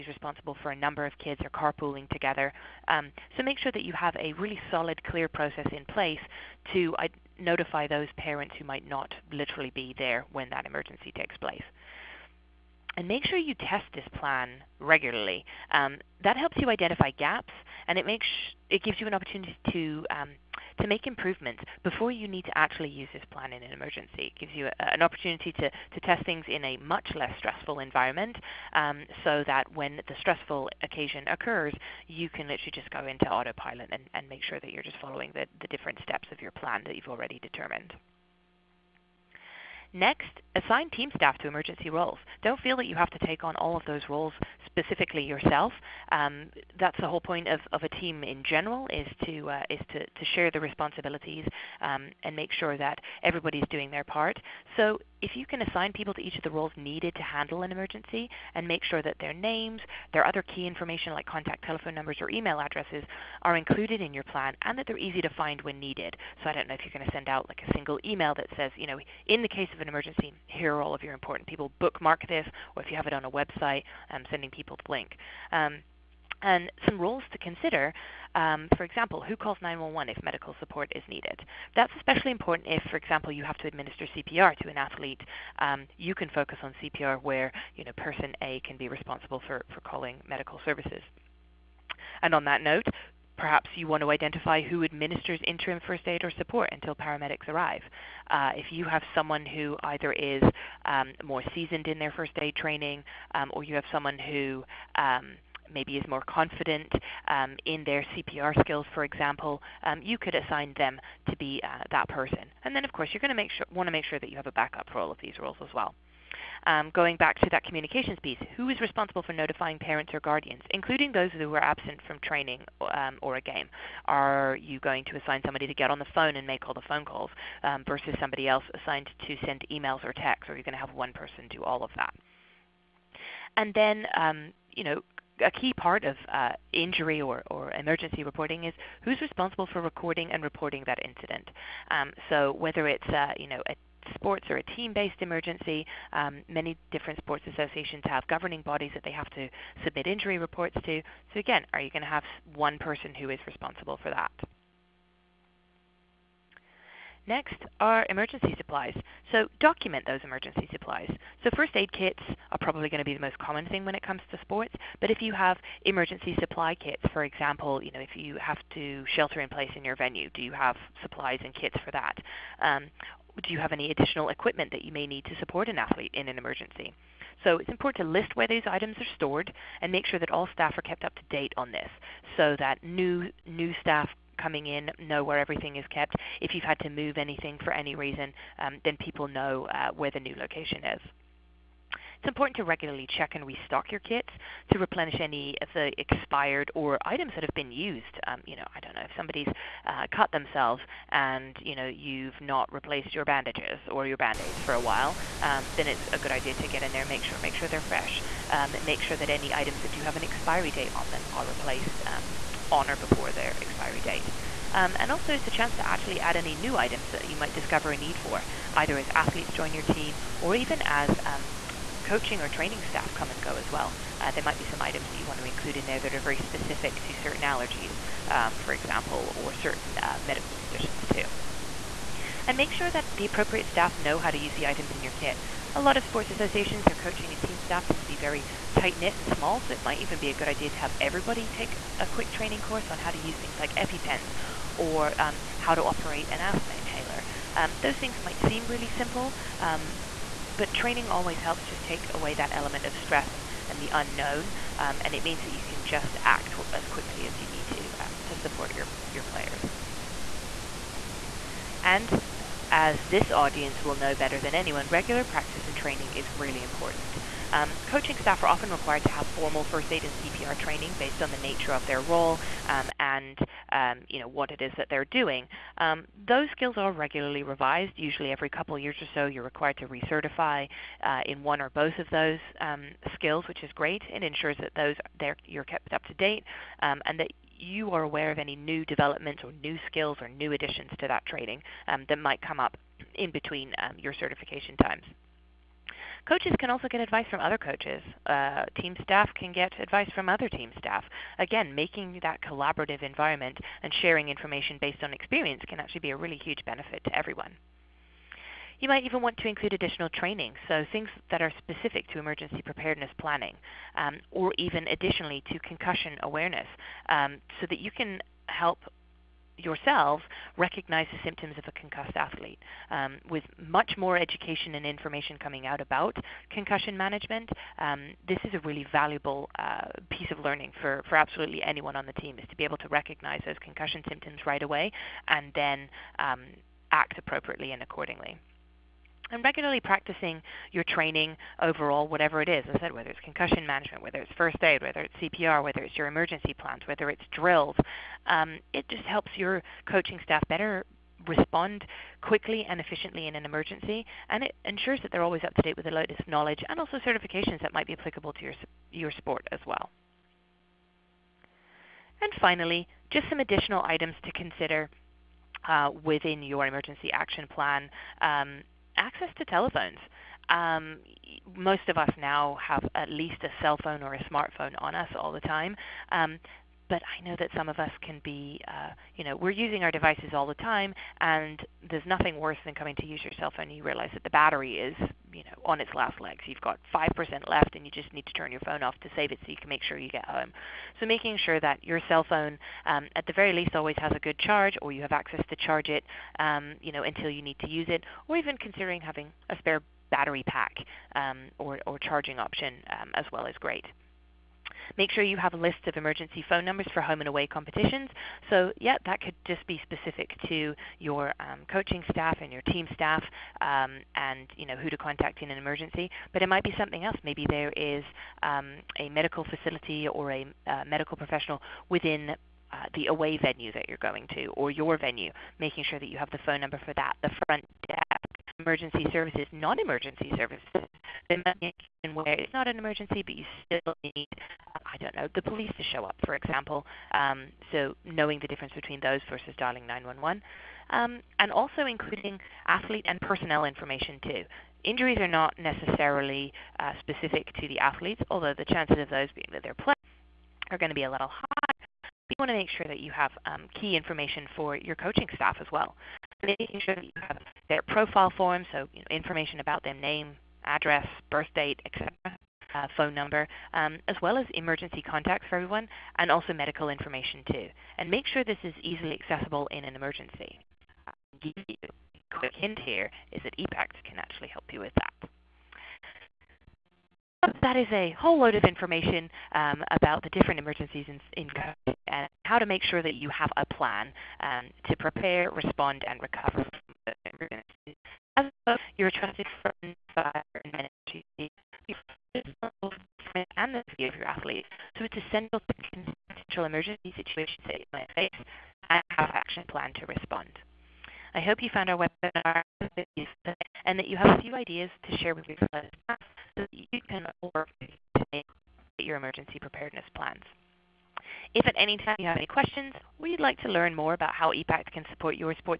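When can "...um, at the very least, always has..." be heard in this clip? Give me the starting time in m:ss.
6:32.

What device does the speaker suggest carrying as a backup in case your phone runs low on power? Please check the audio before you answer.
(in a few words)
spare battery pack.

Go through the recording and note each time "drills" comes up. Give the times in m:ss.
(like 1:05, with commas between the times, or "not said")
5:47.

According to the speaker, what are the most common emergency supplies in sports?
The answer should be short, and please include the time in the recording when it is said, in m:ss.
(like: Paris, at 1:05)
first aid kits, at 2:41.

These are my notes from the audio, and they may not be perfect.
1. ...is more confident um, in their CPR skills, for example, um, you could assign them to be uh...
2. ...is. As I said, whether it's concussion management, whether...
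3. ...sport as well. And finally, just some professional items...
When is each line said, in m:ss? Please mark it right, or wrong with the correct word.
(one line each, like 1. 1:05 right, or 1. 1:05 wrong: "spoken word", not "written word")
1. 1:45 right
2. 5:42 right
3. 5:59 wrong: "additional", not "professional".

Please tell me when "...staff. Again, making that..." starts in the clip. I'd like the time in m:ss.
5:00.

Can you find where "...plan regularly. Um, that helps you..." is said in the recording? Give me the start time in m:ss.
0:14.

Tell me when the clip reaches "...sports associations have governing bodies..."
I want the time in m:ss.
2:27.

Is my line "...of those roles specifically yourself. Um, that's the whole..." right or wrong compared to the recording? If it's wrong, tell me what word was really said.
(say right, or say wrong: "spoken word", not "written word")
right.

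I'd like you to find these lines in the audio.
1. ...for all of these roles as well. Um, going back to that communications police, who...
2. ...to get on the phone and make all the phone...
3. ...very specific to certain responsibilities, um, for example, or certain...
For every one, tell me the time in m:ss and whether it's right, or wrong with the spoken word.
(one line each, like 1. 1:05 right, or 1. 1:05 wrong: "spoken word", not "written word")
1. 1:54 wrong: "piece", not "police"
2. 2:05 right
3. 3:46 wrong: "allergies", not "responsibilities".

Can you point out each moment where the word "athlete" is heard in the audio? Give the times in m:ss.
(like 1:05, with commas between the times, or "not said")
1:24, 2:55, 3:39, 5:22, 7:22, 7:27, 8:14.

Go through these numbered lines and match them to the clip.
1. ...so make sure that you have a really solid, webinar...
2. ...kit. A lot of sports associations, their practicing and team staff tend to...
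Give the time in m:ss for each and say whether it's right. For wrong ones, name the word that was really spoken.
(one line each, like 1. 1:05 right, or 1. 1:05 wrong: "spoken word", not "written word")
1. 0:03 wrong: "clear", not "webinar"
2. 3:55 wrong: "coaching", not "practicing".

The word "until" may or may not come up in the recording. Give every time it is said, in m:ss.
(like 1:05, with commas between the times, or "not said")
1:36, 6:37.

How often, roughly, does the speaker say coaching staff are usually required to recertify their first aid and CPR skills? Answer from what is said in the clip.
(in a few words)
every couple of years.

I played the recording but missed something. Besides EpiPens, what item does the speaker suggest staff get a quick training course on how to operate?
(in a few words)
asthma inhaler.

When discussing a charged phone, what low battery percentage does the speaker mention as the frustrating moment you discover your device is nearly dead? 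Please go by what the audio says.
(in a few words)
5%.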